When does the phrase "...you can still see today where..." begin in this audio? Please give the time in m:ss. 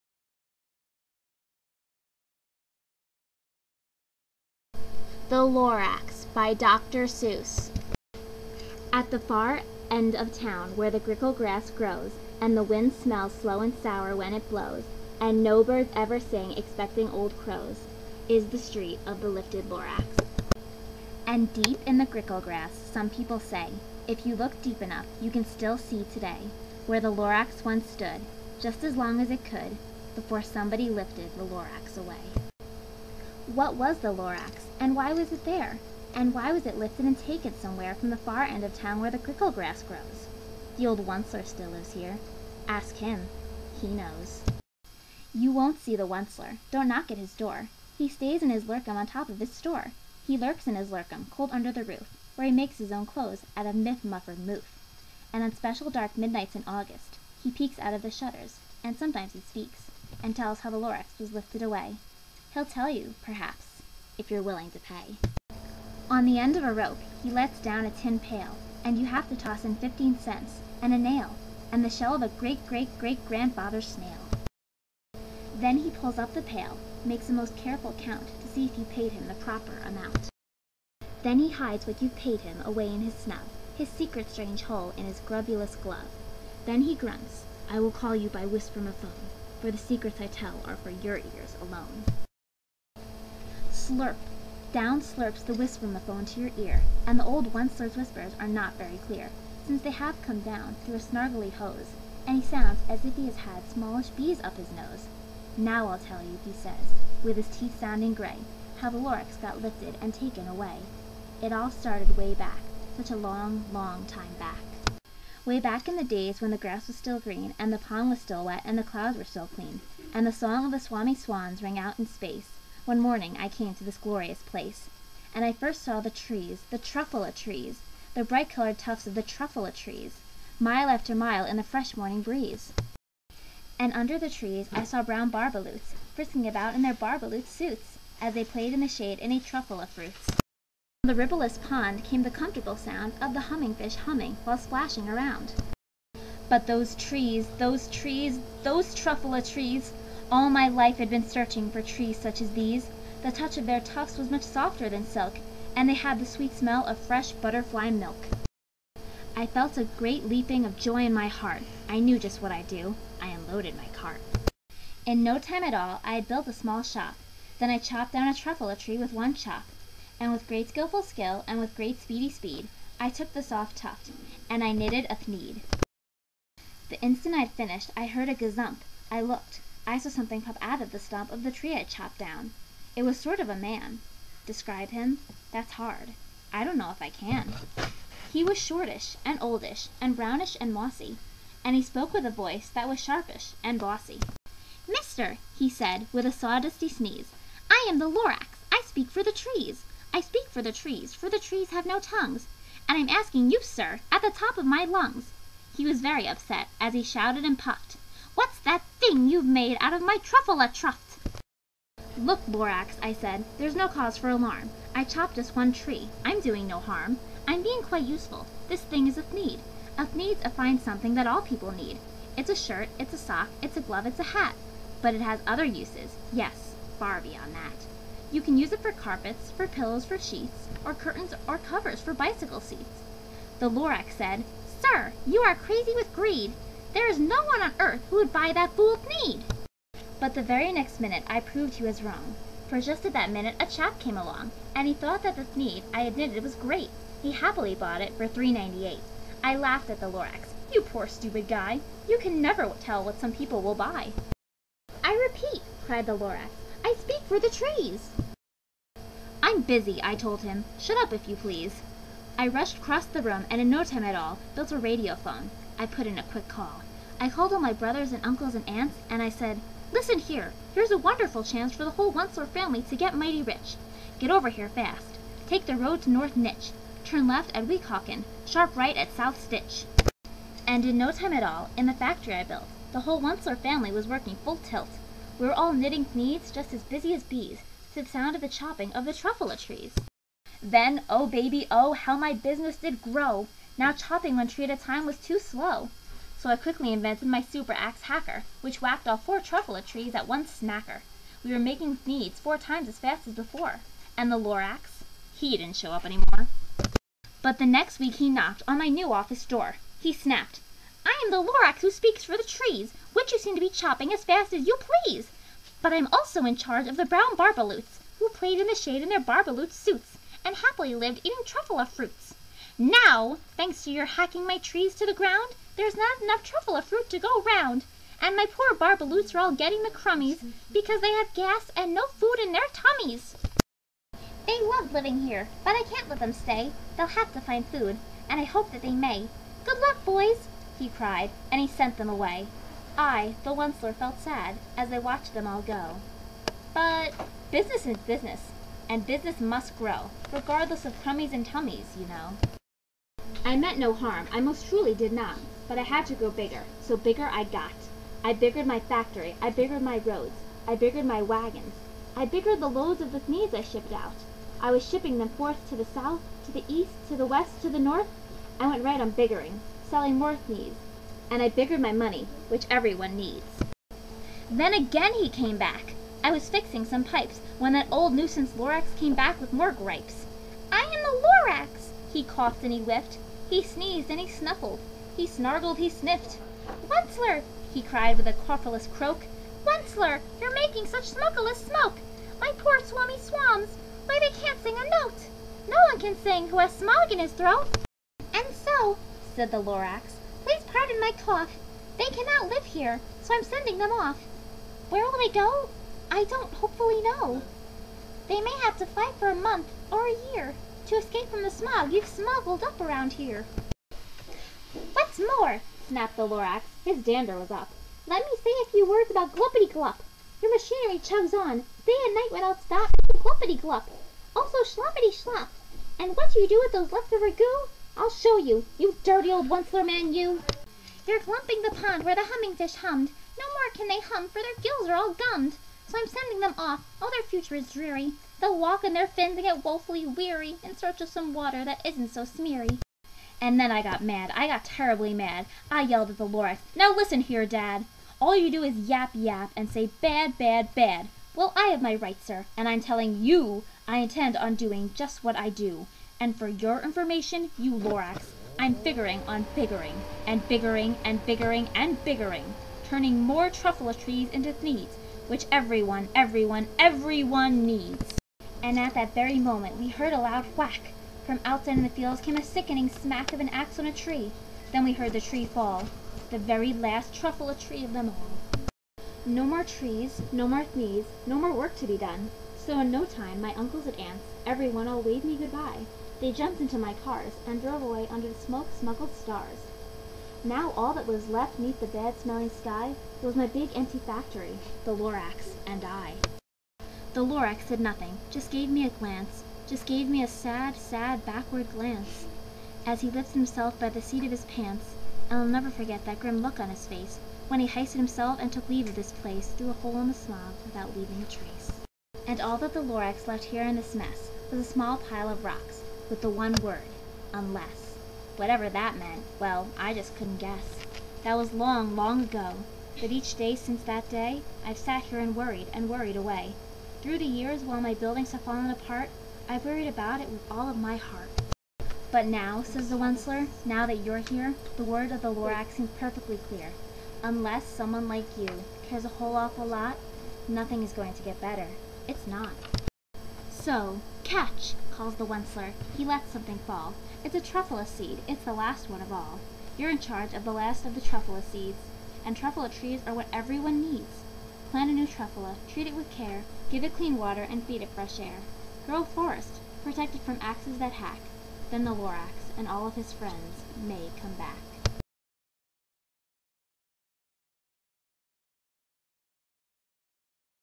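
0:25.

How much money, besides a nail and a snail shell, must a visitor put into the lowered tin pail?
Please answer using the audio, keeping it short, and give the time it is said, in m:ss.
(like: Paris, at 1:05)
15 cents, at 1:09.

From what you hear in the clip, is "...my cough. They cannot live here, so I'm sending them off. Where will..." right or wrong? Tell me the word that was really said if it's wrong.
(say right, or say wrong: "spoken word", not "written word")
right.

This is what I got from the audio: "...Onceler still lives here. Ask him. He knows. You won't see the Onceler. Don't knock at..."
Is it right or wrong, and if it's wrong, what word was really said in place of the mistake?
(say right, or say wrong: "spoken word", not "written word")
right.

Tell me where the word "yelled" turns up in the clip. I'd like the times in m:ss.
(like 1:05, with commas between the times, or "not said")
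7:25.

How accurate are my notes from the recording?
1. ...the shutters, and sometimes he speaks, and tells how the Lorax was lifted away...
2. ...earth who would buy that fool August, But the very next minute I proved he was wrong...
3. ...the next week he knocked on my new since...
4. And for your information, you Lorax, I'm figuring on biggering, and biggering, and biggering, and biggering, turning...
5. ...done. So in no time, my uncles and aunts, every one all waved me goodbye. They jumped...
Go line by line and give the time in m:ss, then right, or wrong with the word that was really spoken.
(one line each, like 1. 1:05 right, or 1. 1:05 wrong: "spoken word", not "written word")
1. 0:58 right
2. 3:57 wrong: "Thneed", not "August"
3. 5:07 wrong: "office", not "since"
4. 7:36 right
5. 8:01 right.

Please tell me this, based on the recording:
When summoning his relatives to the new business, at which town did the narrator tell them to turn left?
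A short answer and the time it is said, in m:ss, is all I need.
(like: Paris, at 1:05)
Weehawken, at 4:37.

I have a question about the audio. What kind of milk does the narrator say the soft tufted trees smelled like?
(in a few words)
fresh butterfly milk.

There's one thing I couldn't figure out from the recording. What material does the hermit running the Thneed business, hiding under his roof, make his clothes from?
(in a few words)
miff muffer moof.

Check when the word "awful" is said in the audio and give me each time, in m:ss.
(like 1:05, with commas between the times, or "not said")
8:59.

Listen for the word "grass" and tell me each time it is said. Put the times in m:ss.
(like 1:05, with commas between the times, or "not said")
0:11, 0:22, 0:39, 1:56.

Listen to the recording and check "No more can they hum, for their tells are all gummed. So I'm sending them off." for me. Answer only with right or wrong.
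wrong.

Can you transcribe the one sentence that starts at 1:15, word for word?
Then he pulls up the pail, makes a most careful count to see if you paid him the proper amount.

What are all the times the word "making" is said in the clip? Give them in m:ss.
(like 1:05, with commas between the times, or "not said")
5:01, 6:30.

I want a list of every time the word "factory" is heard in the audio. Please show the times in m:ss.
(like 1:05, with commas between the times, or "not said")
4:41, 5:58, 8:13.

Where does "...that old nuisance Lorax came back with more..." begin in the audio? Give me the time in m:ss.
6:17.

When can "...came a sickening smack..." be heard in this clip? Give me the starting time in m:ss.
7:52.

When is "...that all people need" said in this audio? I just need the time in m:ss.
3:41.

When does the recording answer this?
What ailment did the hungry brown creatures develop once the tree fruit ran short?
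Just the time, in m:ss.
5:29.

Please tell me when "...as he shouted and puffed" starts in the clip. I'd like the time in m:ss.
3:26.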